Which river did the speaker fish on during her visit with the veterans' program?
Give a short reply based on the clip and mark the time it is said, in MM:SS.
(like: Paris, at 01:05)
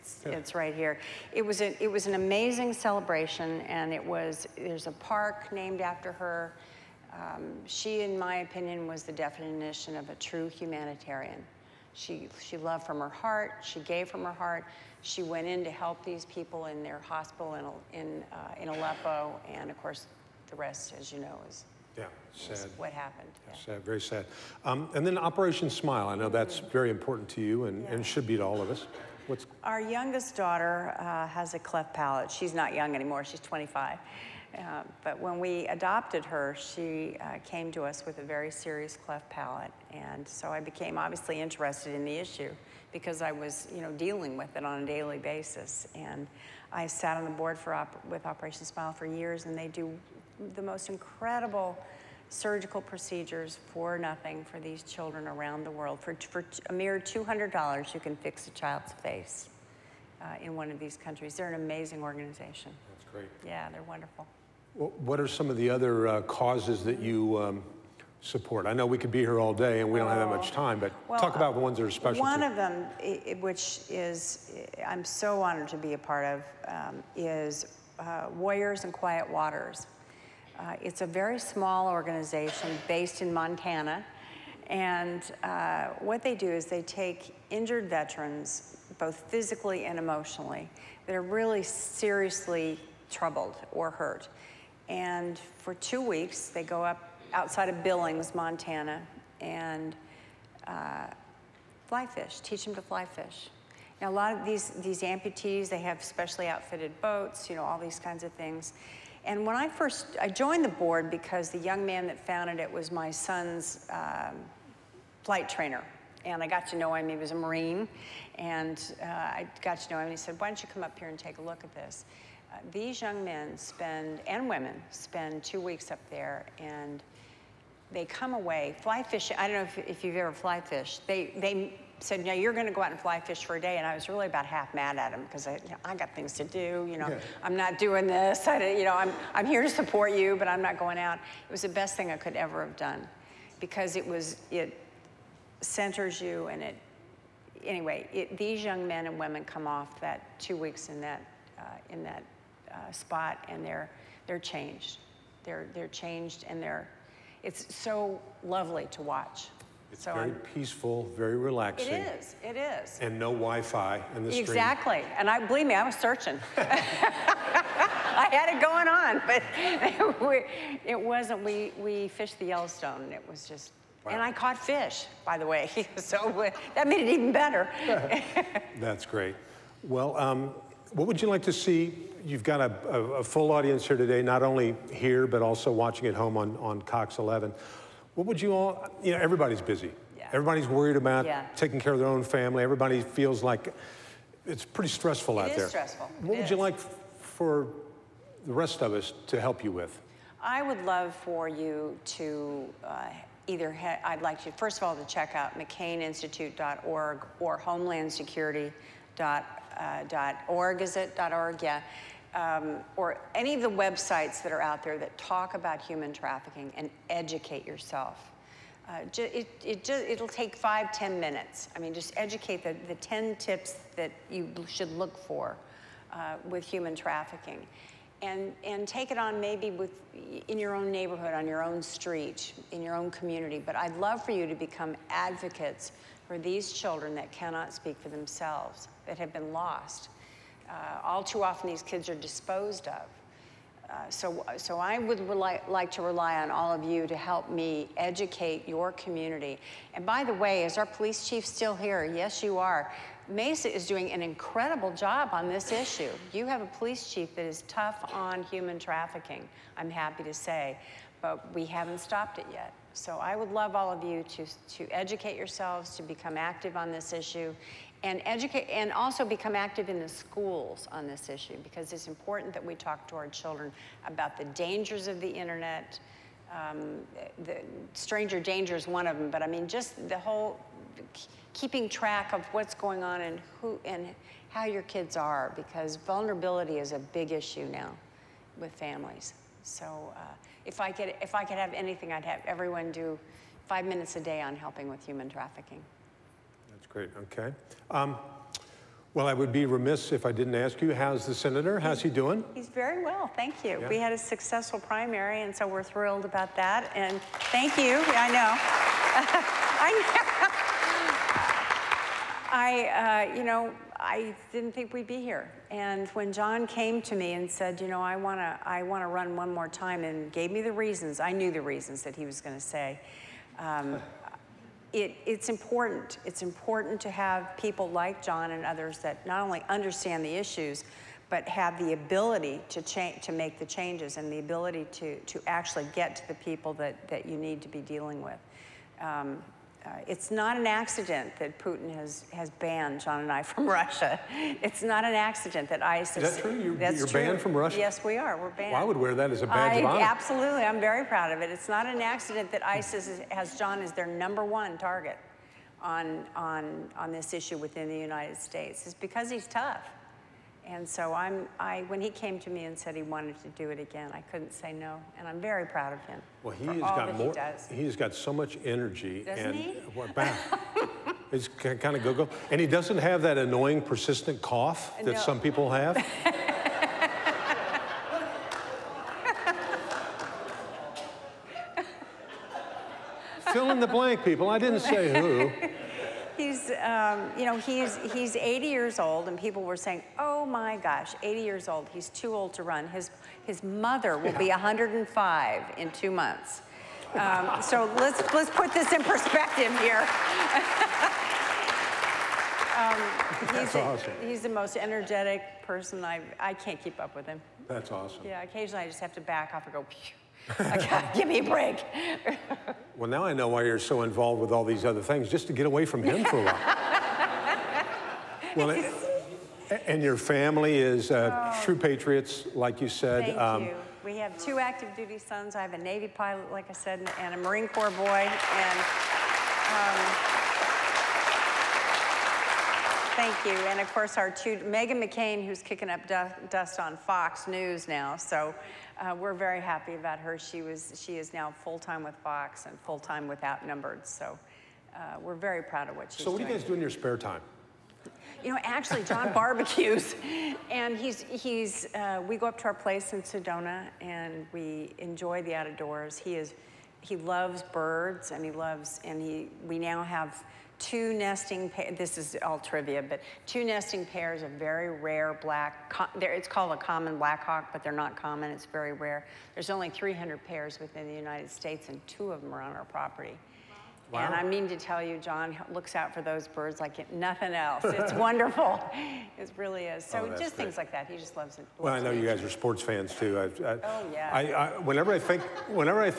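Yellowstone, at 02:52.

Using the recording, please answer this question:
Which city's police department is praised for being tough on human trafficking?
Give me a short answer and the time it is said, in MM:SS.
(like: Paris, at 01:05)
Mesa, at 04:13.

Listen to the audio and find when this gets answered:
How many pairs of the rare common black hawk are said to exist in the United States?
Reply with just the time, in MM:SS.
07:49.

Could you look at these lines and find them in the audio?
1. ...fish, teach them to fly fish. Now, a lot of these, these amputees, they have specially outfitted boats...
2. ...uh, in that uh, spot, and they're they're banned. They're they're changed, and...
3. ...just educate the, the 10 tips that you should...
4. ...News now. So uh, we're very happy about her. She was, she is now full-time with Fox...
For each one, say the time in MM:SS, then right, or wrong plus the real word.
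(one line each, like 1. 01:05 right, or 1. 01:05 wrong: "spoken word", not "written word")
1. 01:42 right
2. 02:31 wrong: "changed", not "banned"
3. 03:41 right
4. 07:17 right.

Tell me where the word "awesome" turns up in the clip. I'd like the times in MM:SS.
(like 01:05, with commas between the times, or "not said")
06:43, 06:47.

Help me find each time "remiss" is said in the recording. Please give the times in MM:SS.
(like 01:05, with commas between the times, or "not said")
04:59.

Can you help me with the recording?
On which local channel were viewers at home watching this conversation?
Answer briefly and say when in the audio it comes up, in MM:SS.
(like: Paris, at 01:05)
Cox 11, at 03:06.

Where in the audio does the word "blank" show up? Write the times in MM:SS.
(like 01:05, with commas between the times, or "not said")
06:23.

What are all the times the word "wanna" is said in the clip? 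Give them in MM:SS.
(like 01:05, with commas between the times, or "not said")
05:18.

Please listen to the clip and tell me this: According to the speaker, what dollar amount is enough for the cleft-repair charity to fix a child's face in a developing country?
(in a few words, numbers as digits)
$200.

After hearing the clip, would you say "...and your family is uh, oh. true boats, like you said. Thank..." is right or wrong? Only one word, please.
wrong.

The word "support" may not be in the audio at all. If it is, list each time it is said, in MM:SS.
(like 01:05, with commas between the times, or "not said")
01:08, 02:19.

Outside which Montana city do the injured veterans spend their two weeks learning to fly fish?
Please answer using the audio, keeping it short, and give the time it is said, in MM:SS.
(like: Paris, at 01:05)
Billings, at 01:37.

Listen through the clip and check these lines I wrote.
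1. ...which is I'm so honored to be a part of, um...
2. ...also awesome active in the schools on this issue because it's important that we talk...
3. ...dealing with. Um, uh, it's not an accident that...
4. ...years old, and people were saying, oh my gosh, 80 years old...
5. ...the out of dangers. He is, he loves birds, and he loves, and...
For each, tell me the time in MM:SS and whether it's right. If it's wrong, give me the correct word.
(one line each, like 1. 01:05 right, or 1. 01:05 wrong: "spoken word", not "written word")
1. 01:13 right
2. 04:28 wrong: "become", not "awesome"
3. 05:37 right
4. 06:28 right
5. 07:35 wrong: "doors", not "dangers".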